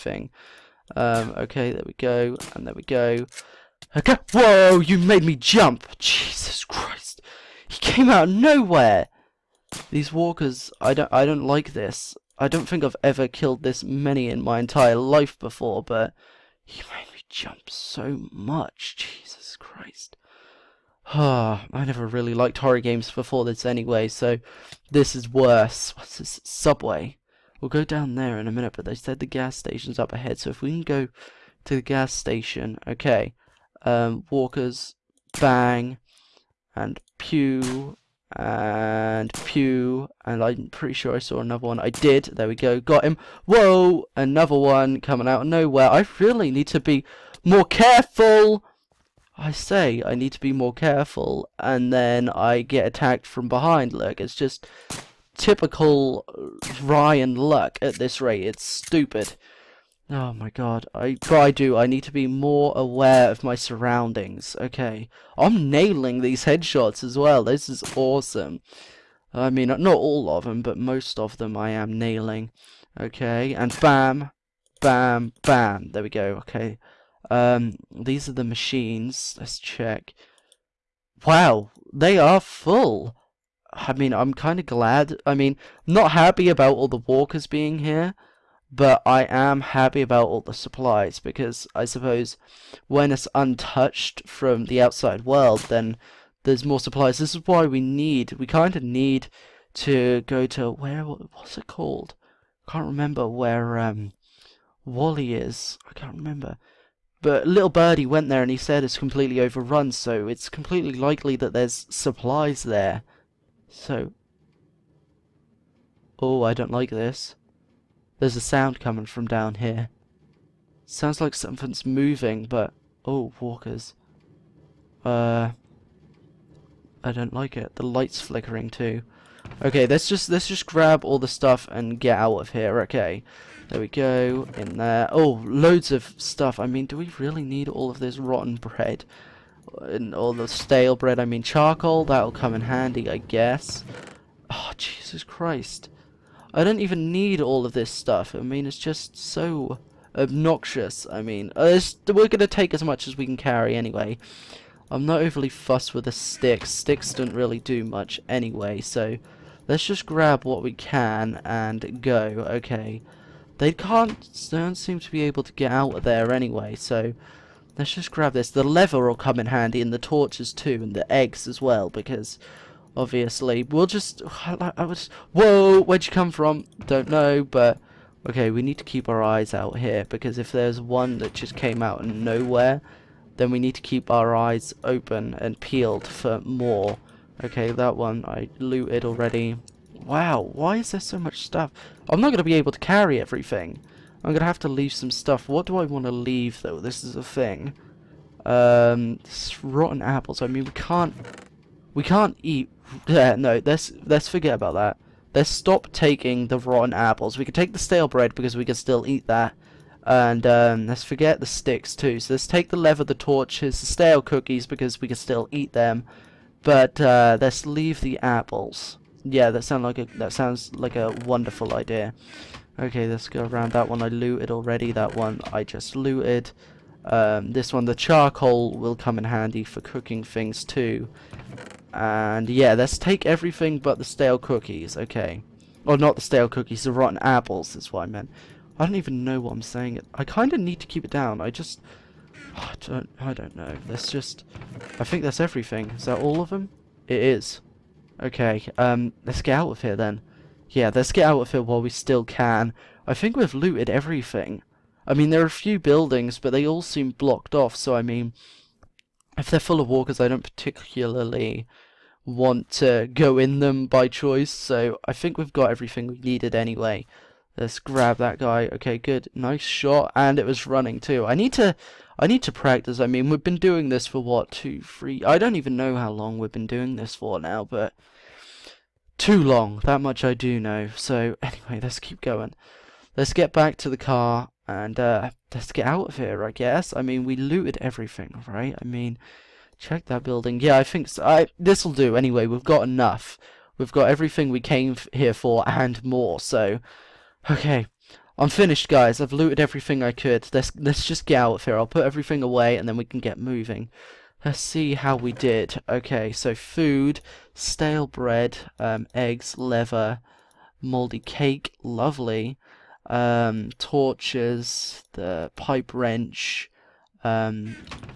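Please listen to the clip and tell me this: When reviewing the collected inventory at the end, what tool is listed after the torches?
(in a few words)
pipe wrench.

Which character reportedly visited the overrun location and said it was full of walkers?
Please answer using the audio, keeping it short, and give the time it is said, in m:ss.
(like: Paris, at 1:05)
Little Birdie, at 1:47.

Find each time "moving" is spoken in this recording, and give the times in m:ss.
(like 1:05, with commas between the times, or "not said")
2:01, 5:03.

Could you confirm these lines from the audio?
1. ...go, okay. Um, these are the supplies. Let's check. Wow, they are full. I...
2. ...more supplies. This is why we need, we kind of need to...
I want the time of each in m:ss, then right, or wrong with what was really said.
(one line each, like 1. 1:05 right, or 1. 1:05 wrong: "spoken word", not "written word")
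1. 1:16 wrong: "machines", not "supplies"
2. 1:36 right.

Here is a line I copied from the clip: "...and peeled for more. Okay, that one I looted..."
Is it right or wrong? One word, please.
right.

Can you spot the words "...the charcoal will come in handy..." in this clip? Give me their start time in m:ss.
3:47.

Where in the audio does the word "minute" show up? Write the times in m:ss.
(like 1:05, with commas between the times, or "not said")
0:28.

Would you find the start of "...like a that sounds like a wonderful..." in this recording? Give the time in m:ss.
3:39.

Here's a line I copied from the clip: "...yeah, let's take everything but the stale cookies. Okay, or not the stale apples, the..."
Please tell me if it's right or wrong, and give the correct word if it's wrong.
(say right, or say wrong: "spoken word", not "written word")
wrong: "cookies", not "apples".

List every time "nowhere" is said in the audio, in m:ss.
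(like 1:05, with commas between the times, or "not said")
0:08, 0:45, 3:02.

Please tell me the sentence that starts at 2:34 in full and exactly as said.
I'm not overly fussed with the sticks.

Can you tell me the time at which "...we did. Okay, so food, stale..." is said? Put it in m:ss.
5:05.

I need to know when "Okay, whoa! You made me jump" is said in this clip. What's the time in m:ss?
0:03.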